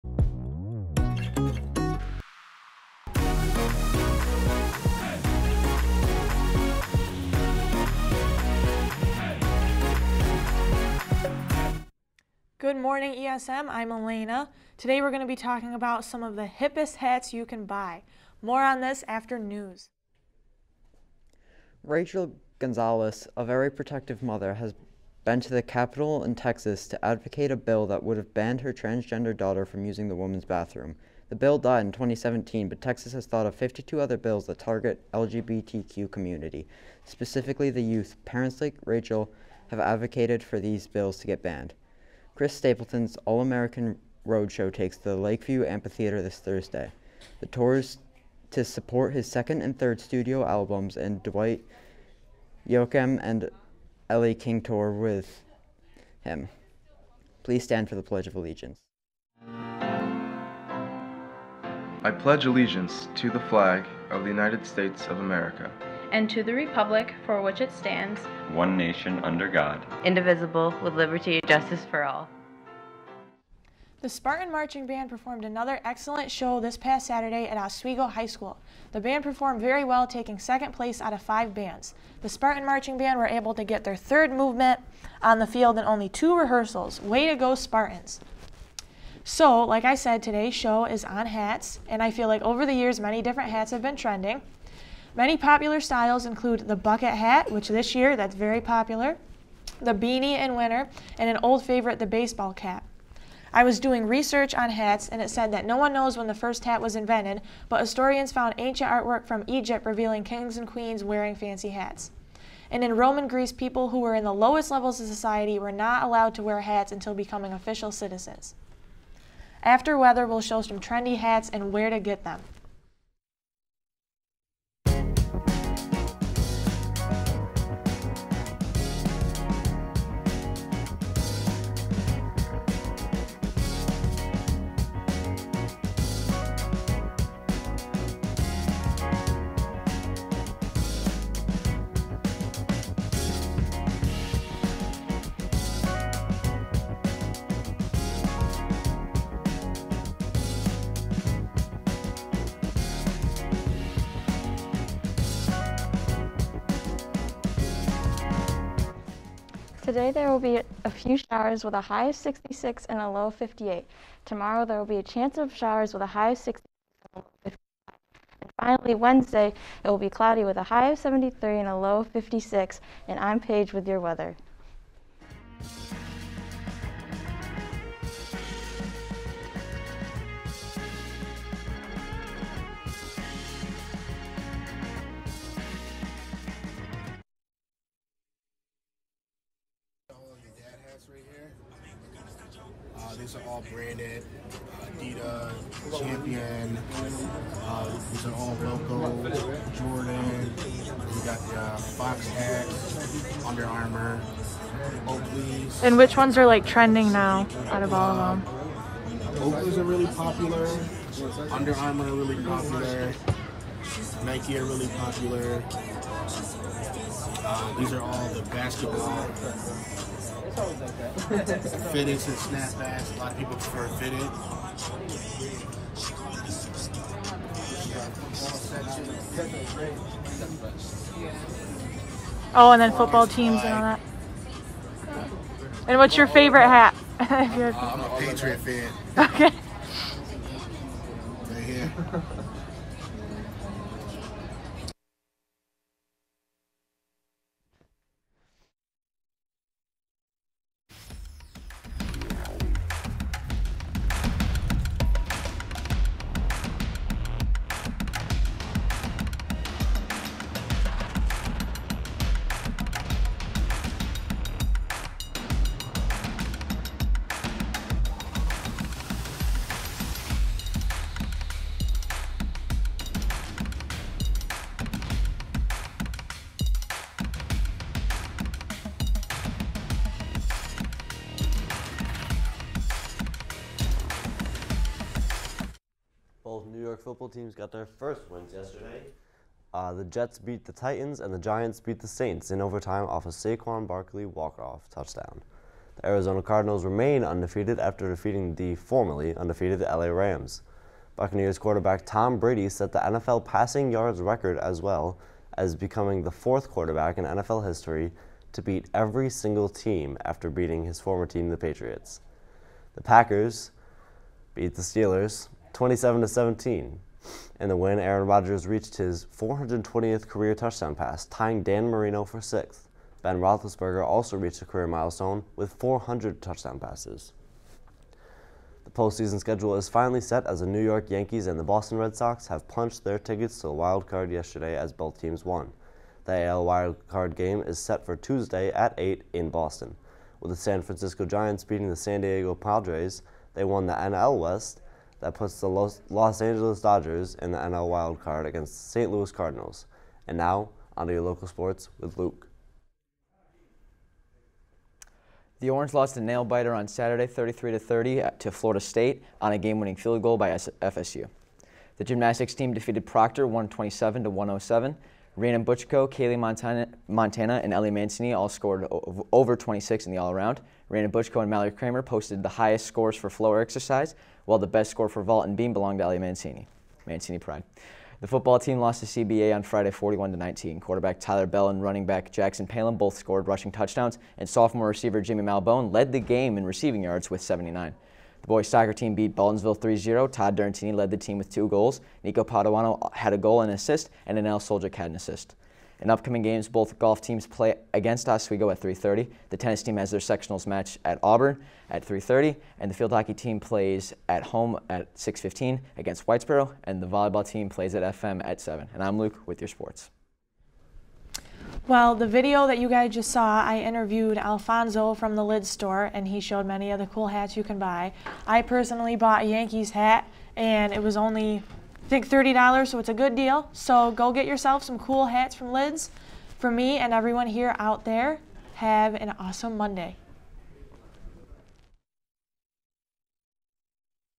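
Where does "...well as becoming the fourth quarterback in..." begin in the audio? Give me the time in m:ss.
5:04.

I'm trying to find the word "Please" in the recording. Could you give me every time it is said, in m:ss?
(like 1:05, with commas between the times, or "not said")
0:57.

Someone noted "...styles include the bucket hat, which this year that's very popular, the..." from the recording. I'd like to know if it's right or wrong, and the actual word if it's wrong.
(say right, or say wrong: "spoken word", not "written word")
right.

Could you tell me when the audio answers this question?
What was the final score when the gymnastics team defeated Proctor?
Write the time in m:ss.
6:03.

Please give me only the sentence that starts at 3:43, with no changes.
A lot of people prefer fitted.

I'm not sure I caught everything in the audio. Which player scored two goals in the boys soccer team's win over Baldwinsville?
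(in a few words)
Todd Durantini.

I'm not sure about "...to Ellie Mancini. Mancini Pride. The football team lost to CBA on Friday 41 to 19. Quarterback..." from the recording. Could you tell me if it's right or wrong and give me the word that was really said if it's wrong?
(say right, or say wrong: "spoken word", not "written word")
right.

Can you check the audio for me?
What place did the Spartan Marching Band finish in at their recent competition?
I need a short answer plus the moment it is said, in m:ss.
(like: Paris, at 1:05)
Second place, at 1:20.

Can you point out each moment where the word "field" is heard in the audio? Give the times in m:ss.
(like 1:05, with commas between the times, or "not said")
1:25, 5:59, 6:42.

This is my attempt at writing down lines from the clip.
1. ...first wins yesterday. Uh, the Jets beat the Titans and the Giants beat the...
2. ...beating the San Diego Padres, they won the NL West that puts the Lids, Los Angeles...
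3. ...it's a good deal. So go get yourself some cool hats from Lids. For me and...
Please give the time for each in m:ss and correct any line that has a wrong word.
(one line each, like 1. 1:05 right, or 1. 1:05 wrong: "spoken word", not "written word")
1. 4:47 right
2. 5:41 wrong: "Los", not "Lids"
3. 7:02 right.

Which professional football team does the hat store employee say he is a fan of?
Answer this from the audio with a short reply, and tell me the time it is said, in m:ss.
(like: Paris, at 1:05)
Patriots, at 3:58.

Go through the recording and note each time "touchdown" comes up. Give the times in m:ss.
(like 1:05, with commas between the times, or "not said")
4:54, 5:20, 5:26, 6:23.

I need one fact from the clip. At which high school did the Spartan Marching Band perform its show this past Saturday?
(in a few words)
Oswego High School.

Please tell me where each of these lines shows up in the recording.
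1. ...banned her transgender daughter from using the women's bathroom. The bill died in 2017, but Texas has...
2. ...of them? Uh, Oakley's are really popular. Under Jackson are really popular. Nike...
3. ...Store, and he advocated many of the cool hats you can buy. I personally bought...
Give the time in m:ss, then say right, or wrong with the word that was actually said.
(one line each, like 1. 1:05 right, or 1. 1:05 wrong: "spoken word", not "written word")
1. 0:28 right
2. 3:28 wrong: "Armour", not "Jackson"
3. 6:55 wrong: "showed", not "advocated".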